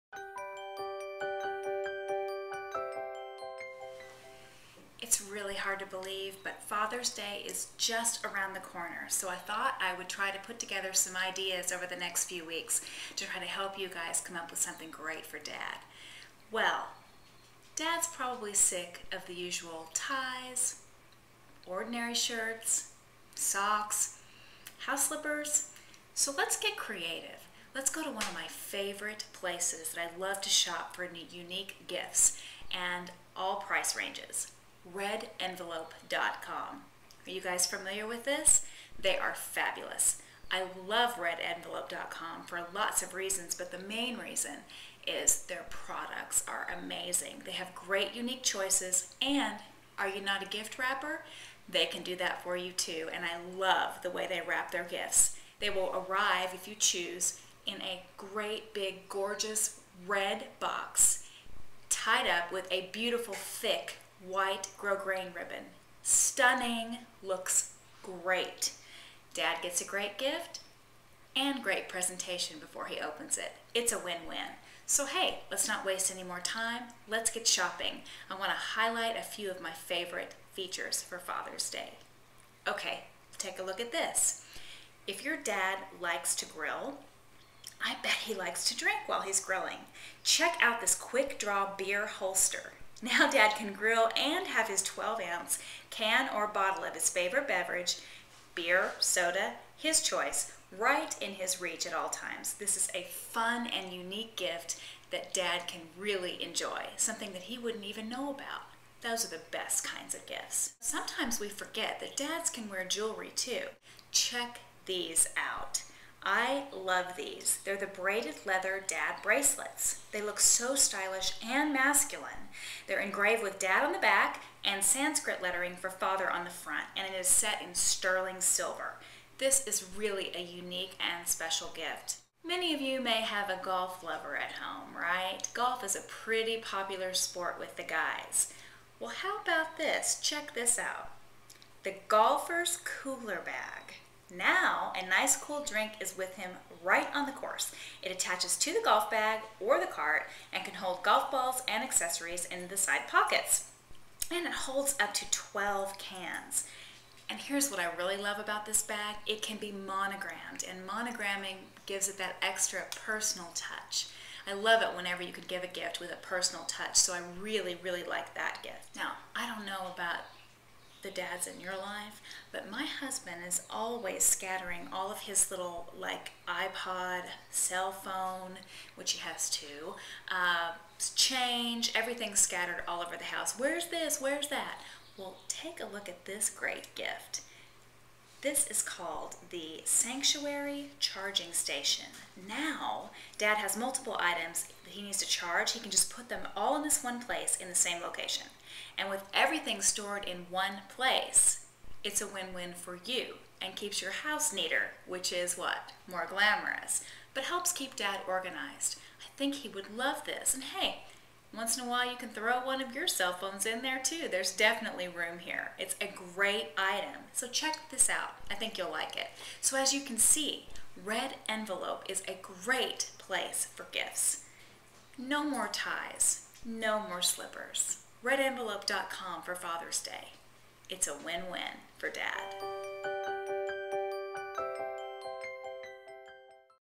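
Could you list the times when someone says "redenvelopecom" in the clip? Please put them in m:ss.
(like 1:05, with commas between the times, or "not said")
0:34, 0:41, 3:48.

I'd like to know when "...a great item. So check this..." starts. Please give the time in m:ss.
3:36.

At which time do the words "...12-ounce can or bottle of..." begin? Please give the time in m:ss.
1:34.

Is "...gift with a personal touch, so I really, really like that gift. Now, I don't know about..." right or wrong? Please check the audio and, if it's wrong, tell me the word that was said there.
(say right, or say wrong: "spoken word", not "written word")
right.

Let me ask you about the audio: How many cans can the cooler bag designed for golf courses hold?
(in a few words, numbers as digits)
12.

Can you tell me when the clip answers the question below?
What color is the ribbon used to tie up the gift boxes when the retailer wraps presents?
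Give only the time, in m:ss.
1:04.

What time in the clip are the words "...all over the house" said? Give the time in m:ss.
3:02.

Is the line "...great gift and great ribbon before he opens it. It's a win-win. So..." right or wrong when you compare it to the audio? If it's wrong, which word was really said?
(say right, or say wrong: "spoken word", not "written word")
wrong: "presentation", not "ribbon".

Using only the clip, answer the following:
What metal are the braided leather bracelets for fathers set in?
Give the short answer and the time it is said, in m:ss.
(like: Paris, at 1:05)
sterling silver, at 2:07.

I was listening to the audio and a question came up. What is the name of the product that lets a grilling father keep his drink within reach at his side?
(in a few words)
quick draw beer holster.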